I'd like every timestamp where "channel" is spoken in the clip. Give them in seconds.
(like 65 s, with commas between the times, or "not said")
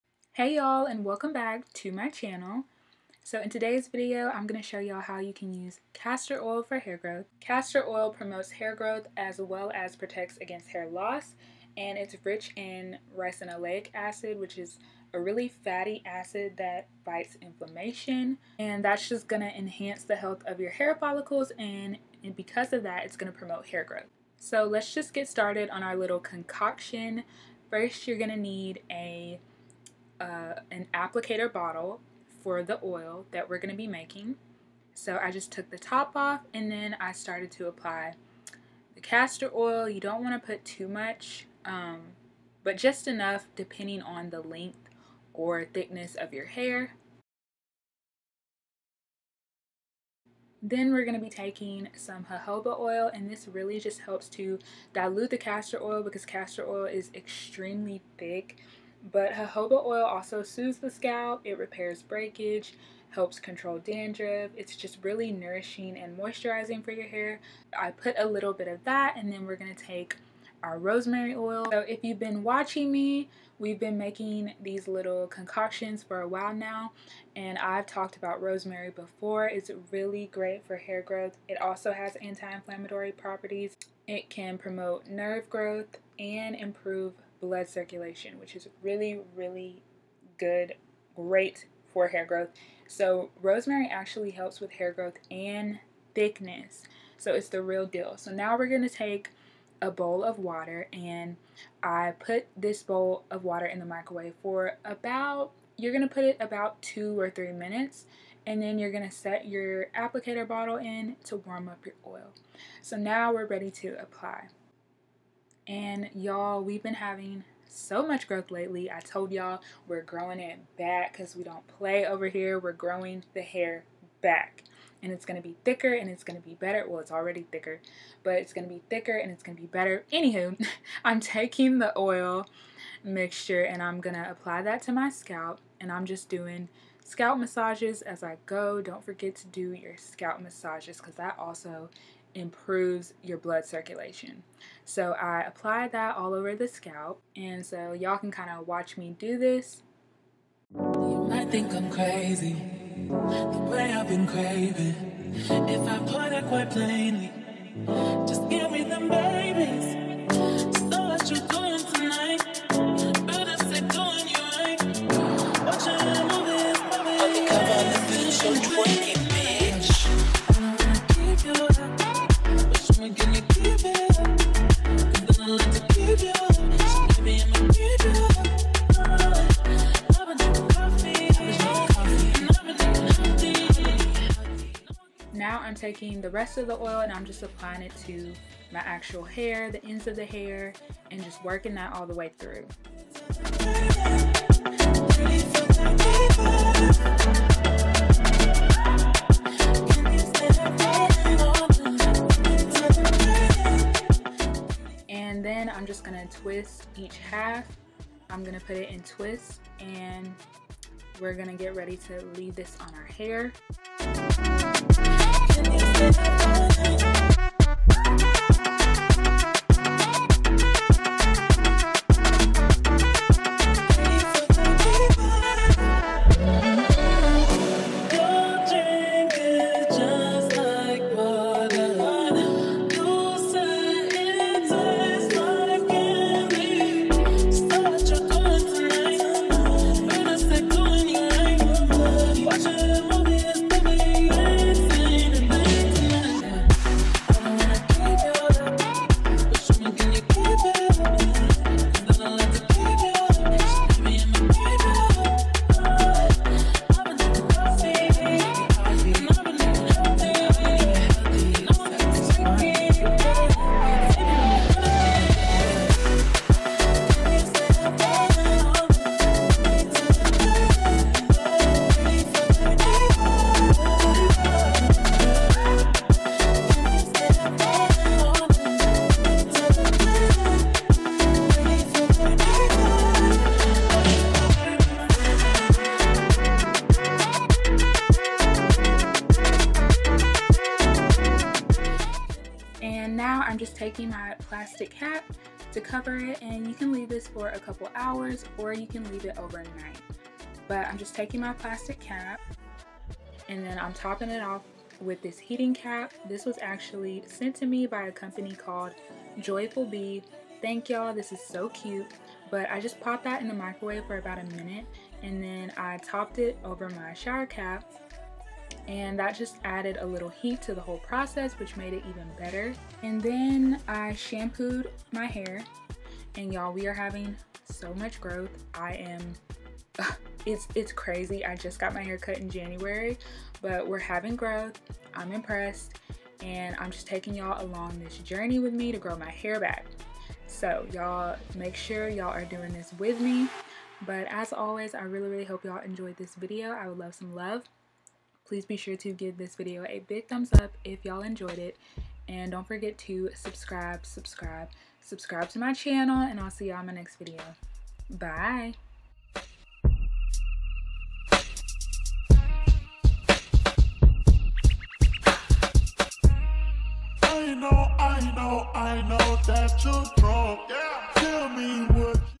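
2 s, 355 s.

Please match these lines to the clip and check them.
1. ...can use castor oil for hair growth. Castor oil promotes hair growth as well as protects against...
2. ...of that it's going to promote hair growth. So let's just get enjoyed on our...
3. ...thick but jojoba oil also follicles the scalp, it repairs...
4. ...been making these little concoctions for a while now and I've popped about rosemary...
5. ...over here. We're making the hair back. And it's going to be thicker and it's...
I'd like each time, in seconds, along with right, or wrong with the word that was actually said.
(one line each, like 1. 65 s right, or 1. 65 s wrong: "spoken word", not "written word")
1. 5 s right
2. 22 s wrong: "started", not "enjoyed"
3. 58 s wrong: "soothes", not "follicles"
4. 73 s wrong: "talked", not "popped"
5. 122 s wrong: "growing", not "making".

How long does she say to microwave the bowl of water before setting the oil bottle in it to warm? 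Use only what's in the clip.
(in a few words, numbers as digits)
2 or 3 minutes.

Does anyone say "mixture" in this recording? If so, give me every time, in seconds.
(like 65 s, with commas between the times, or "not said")
133 s.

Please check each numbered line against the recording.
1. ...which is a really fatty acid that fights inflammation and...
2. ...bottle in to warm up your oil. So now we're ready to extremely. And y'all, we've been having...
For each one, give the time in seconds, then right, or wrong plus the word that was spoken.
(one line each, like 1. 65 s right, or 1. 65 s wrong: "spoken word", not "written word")
1. 14 s right
2. 110 s wrong: "apply", not "extremely".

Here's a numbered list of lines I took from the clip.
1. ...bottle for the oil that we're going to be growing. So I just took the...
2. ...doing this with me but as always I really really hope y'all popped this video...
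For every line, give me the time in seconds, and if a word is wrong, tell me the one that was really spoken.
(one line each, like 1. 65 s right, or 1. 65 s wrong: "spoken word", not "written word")
1. 31 s wrong: "making", not "growing"
2. 342 s wrong: "enjoyed", not "popped".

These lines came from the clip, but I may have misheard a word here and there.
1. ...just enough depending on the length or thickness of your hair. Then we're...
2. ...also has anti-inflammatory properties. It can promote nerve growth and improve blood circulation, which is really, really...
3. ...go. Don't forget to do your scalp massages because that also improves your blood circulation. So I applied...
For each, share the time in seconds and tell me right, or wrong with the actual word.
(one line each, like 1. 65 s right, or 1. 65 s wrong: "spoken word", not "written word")
1. 42 s right
2. 81 s right
3. 138 s right.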